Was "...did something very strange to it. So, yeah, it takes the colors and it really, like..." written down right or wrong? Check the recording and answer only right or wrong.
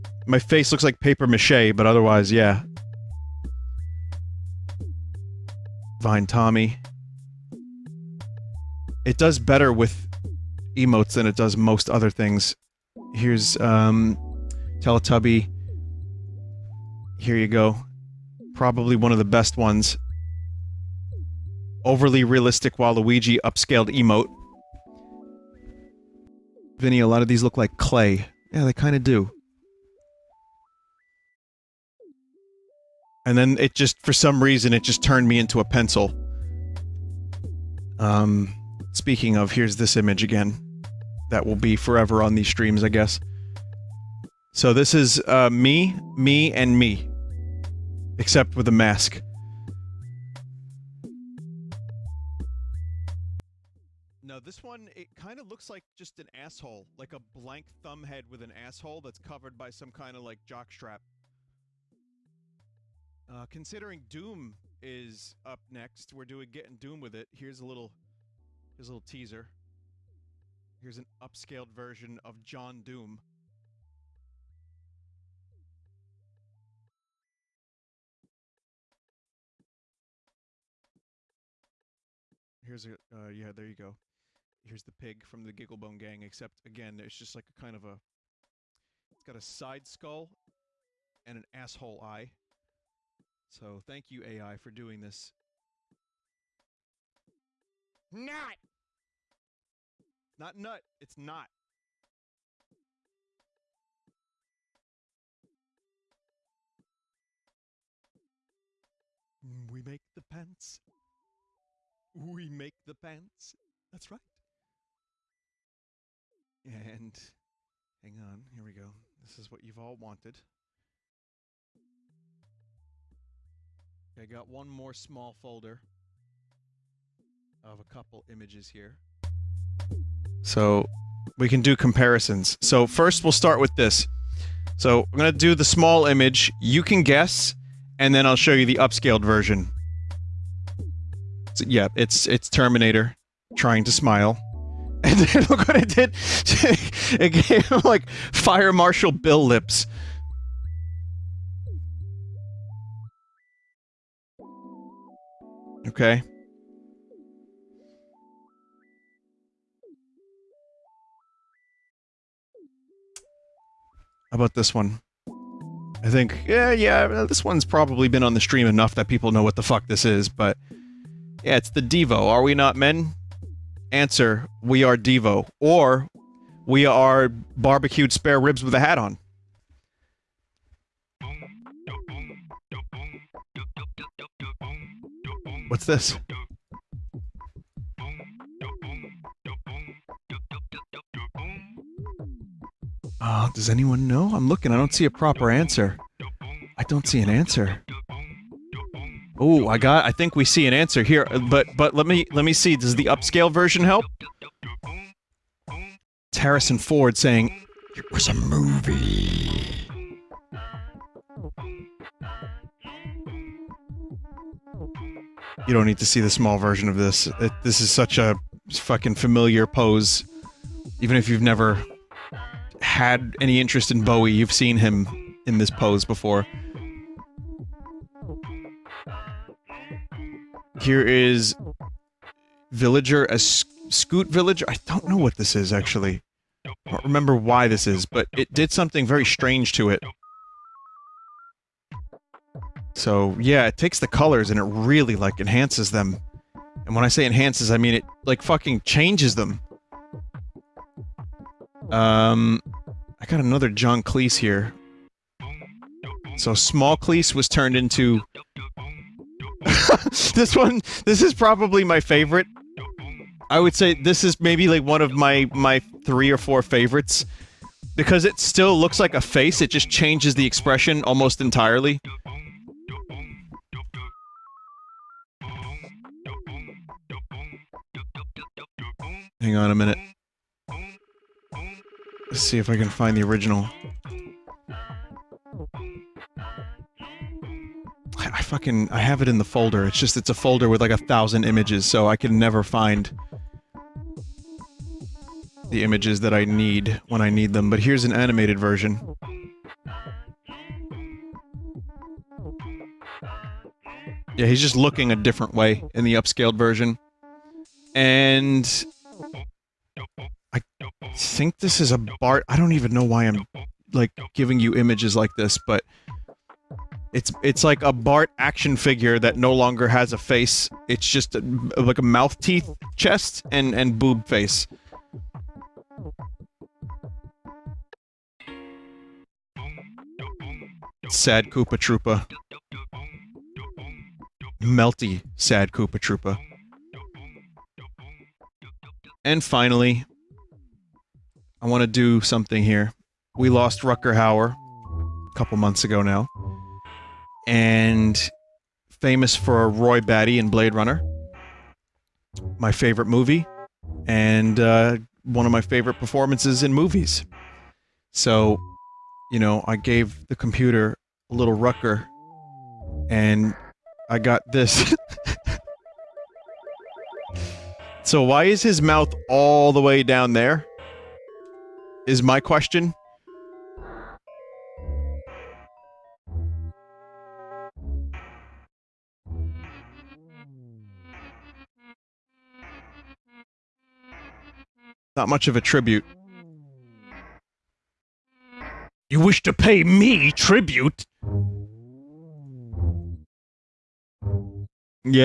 right.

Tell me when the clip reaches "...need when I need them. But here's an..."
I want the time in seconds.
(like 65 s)
296 s.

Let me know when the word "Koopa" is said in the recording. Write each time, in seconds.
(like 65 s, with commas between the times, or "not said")
331 s, 335 s.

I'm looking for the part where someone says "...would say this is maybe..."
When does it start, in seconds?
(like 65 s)
263 s.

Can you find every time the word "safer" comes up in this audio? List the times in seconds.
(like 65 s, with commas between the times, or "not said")
not said.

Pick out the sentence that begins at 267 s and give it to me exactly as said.
Because it still looks like a face, it just changes the expression almost entirely.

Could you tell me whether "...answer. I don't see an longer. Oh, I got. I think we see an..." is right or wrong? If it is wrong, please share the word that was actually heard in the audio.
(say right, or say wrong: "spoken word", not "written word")
wrong: "answer", not "longer".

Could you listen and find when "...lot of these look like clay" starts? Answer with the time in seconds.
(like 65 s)
27 s.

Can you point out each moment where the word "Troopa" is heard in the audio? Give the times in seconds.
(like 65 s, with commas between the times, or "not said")
331 s, 335 s.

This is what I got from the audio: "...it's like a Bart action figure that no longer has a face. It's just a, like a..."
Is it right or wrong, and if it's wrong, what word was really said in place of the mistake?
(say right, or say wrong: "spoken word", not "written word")
right.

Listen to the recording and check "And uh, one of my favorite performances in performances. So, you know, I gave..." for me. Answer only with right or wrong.
wrong.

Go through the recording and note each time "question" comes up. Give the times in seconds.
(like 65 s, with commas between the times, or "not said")
372 s.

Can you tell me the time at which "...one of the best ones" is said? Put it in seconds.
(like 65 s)
18 s.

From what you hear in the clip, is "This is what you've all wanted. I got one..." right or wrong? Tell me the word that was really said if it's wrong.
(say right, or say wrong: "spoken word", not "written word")
right.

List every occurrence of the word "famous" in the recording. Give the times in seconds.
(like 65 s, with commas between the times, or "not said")
348 s.